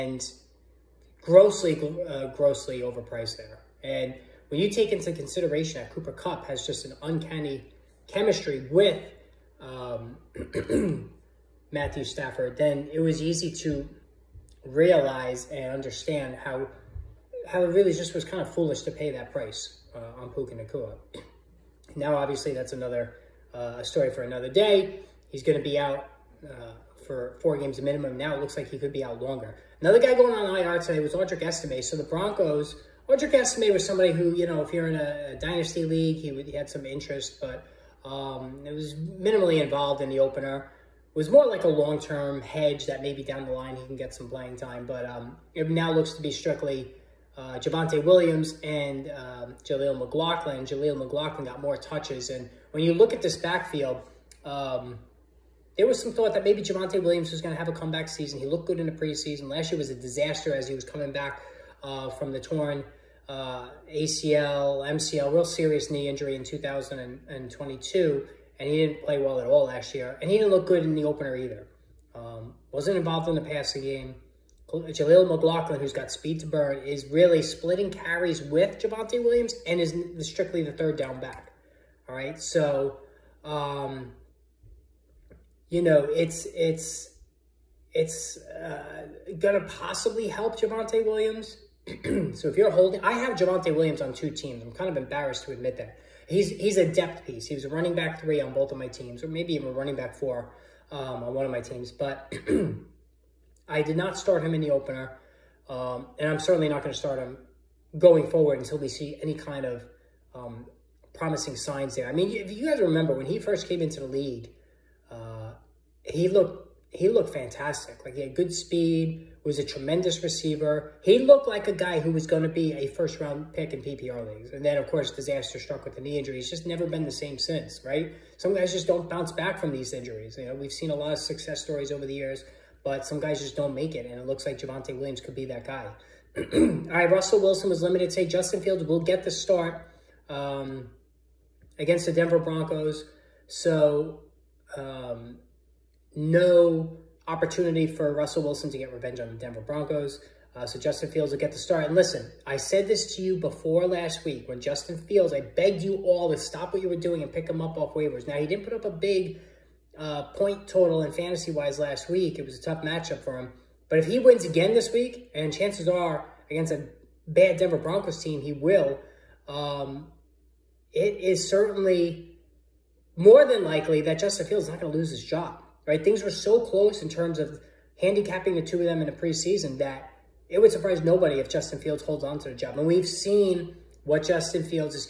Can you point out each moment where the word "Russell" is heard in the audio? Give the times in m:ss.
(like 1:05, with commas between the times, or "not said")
2:17, 2:28.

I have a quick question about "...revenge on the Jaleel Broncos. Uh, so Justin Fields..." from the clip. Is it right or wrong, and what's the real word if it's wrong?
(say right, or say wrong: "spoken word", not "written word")
wrong: "Denver", not "Jaleel".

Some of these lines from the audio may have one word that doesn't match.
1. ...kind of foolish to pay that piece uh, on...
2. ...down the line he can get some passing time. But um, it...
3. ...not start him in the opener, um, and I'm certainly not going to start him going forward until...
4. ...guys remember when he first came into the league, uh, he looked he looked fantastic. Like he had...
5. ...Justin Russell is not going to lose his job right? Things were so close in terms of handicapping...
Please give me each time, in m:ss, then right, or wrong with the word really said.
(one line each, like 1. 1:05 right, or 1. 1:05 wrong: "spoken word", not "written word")
1. 0:18 wrong: "price", not "piece"
2. 0:43 wrong: "playing", not "passing"
3. 1:43 right
4. 1:52 right
5. 2:54 wrong: "Fields", not "Russell".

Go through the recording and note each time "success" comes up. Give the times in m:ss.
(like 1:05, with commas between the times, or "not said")
2:11.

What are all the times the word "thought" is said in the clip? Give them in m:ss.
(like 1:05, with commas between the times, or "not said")
0:56.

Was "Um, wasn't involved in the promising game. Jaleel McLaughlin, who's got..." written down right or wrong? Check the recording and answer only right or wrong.
wrong.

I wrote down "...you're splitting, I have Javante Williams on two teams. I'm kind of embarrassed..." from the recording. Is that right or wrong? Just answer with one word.
wrong.